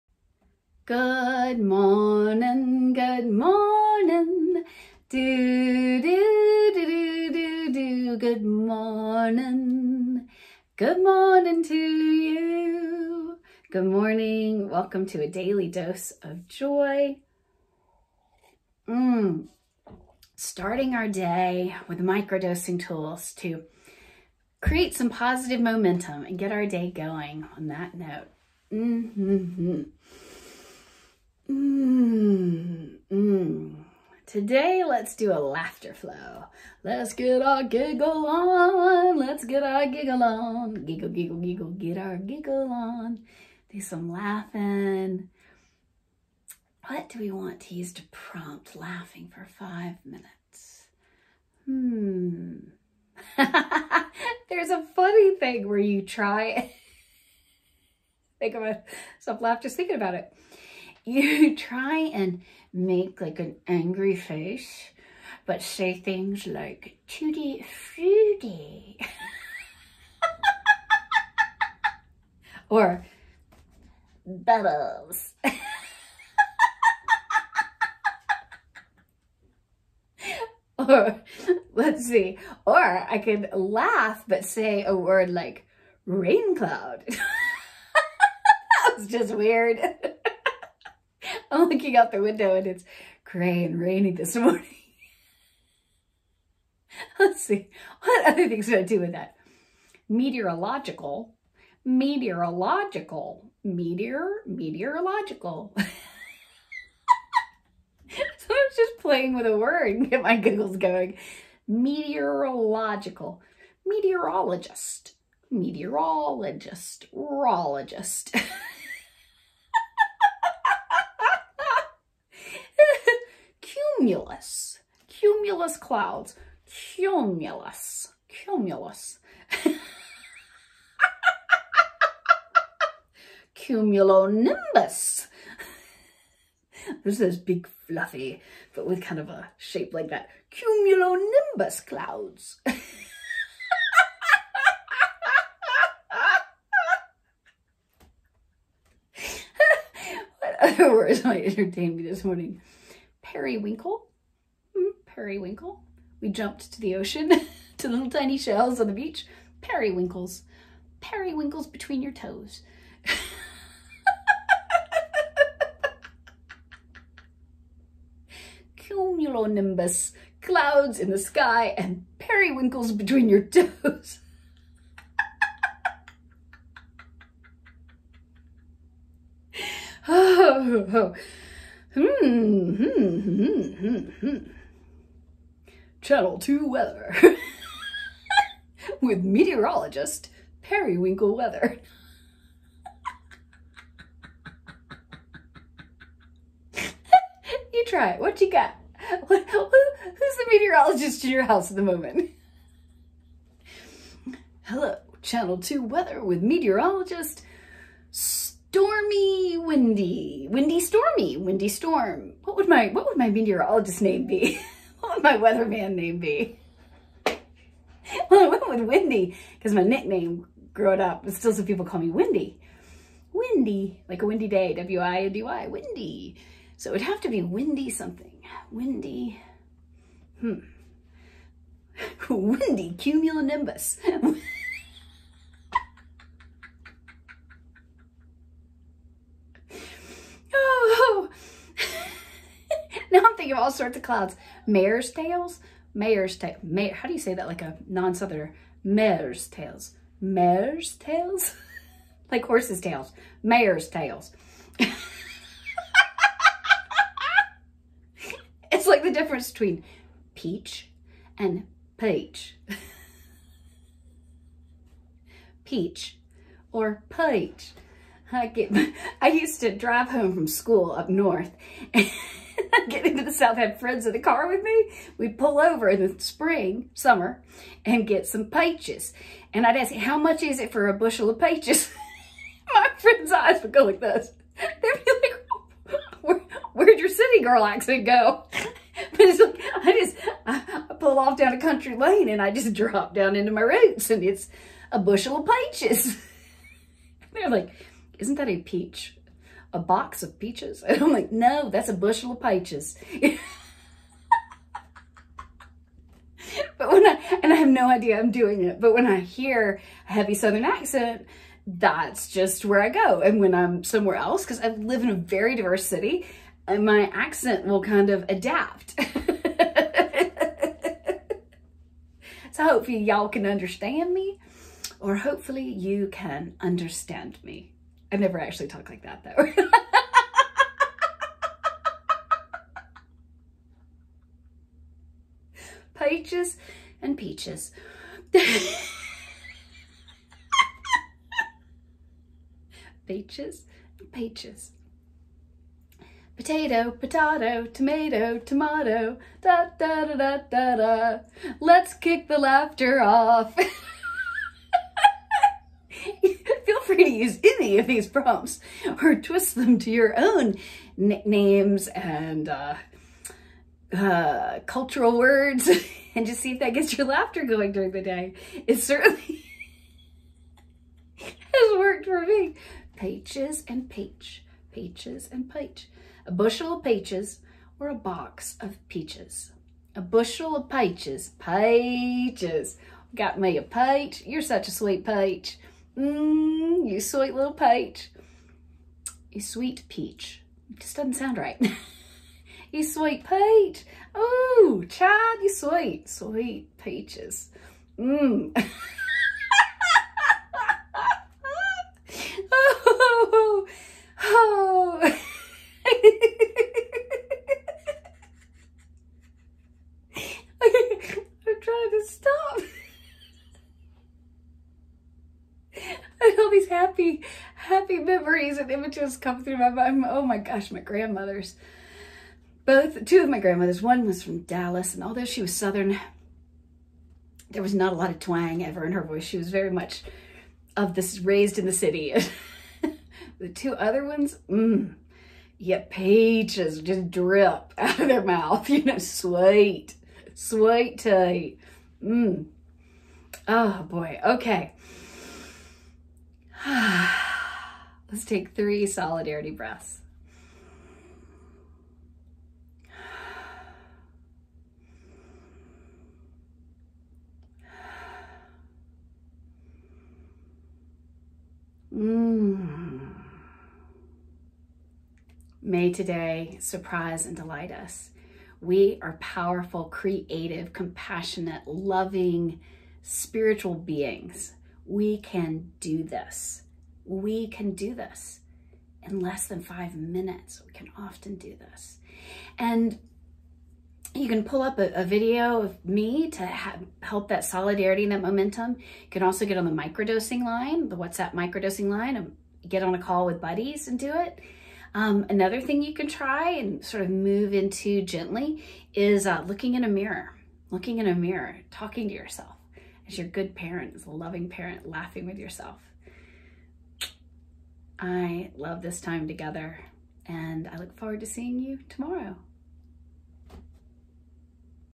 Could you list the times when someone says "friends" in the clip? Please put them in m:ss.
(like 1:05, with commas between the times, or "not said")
4:33, 4:42.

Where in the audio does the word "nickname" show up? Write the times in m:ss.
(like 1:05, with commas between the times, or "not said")
3:39, 6:00.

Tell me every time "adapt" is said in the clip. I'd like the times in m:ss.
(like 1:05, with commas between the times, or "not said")
5:18.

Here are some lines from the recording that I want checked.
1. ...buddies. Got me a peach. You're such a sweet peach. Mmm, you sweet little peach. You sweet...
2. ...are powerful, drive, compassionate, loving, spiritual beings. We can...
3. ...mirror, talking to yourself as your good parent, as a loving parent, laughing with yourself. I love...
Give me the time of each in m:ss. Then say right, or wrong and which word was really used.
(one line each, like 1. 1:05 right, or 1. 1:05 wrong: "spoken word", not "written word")
1. 6:21 wrong: "peaches", not "buddies"
2. 7:49 wrong: "creative", not "drive"
3. 8:21 right.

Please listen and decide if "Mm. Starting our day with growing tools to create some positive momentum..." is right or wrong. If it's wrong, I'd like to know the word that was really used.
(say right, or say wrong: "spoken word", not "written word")
wrong: "microdosing", not "growing".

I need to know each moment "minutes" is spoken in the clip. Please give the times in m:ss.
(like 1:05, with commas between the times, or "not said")
0:50, 7:59.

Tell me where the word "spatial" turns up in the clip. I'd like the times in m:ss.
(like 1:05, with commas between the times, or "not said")
not said.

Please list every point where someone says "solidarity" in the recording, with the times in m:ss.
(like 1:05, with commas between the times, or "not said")
7:28, 8:07.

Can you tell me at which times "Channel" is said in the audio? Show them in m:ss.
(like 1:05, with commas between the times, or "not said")
3:06, 3:25.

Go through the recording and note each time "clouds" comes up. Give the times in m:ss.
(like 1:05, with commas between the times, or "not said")
1:26, 2:05, 2:21, 2:50, 4:04.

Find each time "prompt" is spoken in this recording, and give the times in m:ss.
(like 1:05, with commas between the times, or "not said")
0:48, 5:58.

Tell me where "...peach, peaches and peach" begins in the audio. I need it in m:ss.
6:13.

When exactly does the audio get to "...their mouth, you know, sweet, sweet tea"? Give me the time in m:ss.
7:18.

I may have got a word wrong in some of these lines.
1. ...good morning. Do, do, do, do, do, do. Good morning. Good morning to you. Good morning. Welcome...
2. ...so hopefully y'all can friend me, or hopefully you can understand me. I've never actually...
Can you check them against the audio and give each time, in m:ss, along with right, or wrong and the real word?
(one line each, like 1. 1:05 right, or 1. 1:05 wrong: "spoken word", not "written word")
1. 0:02 right
2. 5:22 wrong: "understand", not "friend".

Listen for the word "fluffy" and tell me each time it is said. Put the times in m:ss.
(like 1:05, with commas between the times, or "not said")
2:17.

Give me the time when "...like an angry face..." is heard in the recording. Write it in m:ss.
1:03.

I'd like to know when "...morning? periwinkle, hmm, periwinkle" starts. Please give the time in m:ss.
2:32.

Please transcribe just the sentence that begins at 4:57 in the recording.
They're like, isn't that a peach?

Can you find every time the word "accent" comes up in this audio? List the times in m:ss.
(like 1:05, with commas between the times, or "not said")
4:47, 5:10, 5:17.